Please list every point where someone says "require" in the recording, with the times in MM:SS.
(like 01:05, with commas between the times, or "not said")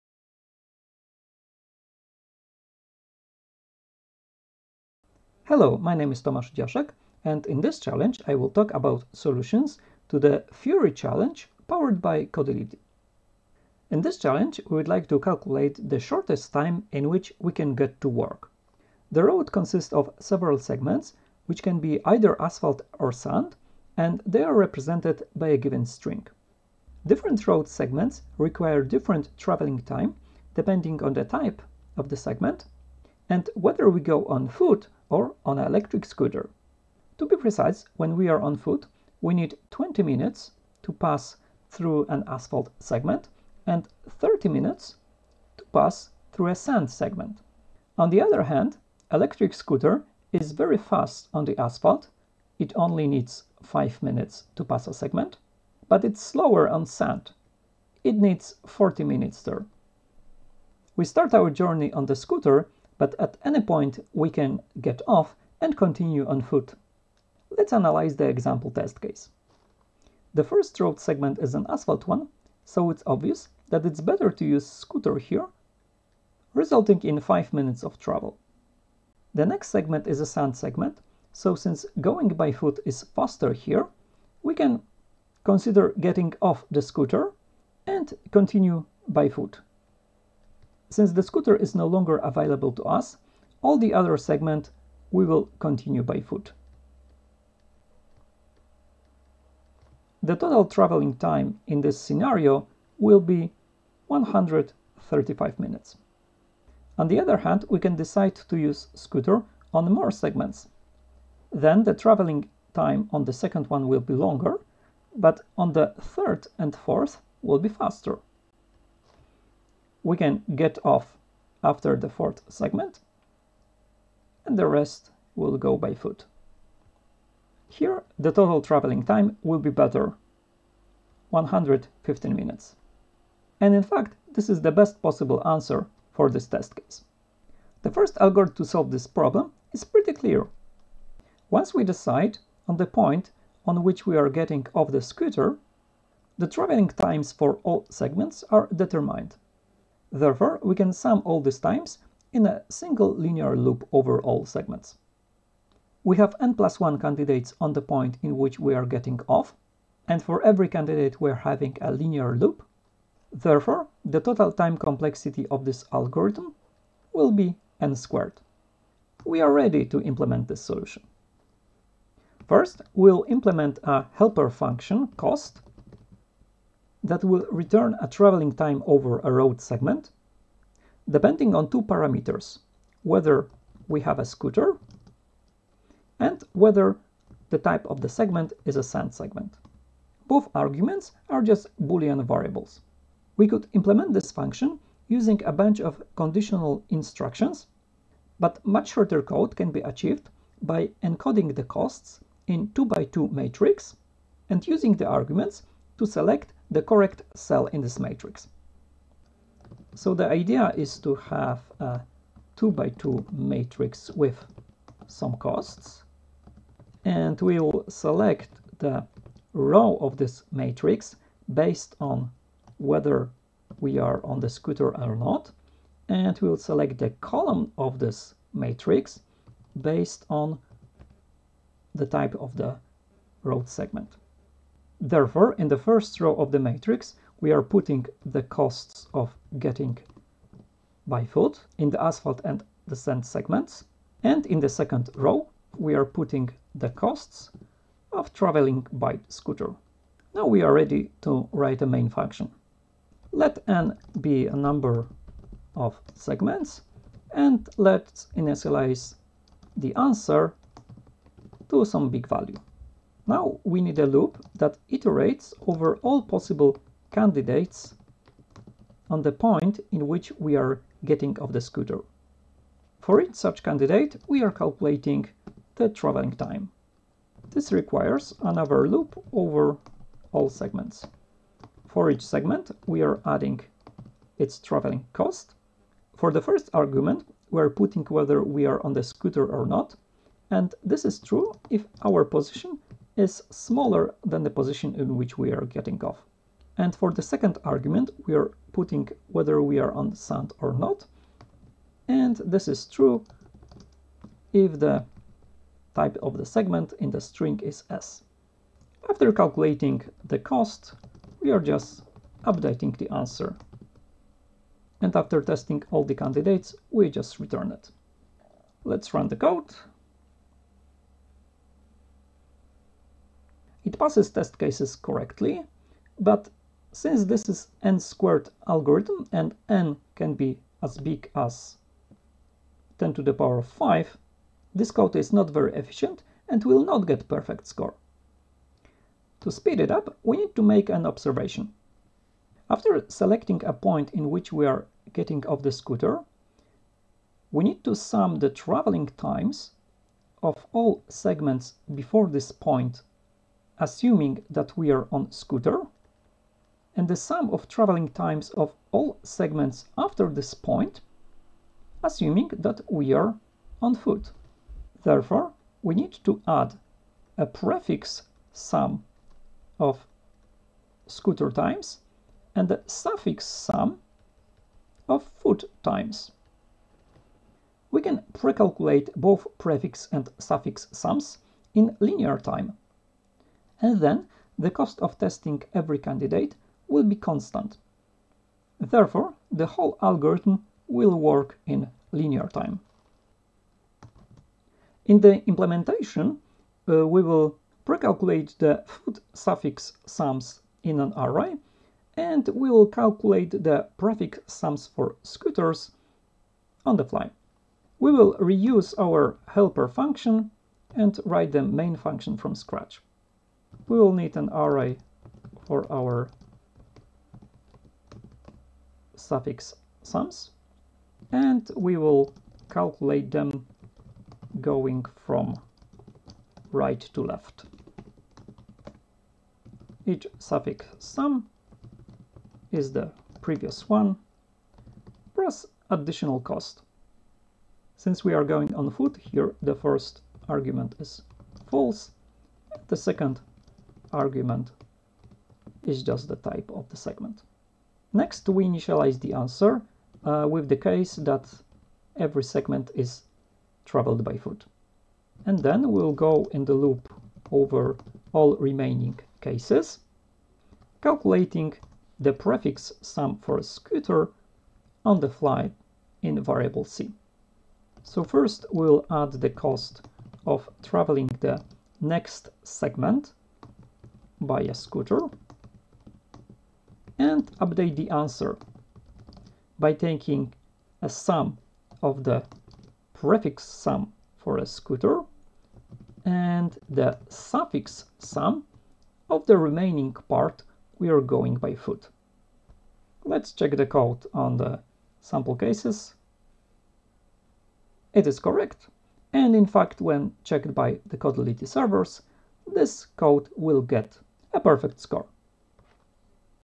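00:28, 04:37.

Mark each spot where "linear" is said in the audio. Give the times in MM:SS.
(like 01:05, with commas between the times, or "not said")
02:33, 02:41, 06:21, 06:32.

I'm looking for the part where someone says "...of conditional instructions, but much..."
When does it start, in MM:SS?
03:15.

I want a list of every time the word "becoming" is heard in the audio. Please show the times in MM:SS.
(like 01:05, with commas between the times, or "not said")
not said.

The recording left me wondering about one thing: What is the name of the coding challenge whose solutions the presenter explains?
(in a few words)
Fury.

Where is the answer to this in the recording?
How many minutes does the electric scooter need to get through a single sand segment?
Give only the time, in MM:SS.
00:58.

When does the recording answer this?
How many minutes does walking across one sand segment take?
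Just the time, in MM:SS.
00:44.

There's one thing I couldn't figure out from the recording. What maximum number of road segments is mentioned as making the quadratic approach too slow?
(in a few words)
10^5.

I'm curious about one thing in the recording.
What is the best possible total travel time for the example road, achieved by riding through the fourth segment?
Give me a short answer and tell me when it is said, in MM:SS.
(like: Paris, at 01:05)
115 minutes, at 02:11.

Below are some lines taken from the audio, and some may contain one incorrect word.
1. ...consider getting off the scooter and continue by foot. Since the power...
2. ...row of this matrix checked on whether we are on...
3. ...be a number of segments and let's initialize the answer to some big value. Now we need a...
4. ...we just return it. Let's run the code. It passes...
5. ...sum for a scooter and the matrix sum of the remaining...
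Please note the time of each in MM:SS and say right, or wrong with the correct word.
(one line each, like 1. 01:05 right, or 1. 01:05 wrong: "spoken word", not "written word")
1. 01:25 wrong: "scooter", not "power"
2. 03:39 wrong: "based", not "checked"
3. 04:14 right
4. 05:16 right
5. 08:03 wrong: "suffix", not "matrix".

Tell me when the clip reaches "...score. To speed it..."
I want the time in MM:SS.
05:37.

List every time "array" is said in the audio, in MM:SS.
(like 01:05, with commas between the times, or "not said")
06:41, 06:54.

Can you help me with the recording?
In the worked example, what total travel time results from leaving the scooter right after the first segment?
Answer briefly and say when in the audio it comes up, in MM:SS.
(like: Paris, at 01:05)
135 minutes, at 01:44.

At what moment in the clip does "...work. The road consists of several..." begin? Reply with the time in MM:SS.
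00:18.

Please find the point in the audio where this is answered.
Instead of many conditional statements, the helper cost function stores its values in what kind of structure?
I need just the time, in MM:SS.
03:22.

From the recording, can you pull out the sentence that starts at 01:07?
Let's analyze the example test case.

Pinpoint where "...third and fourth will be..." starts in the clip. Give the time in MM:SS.
01:56.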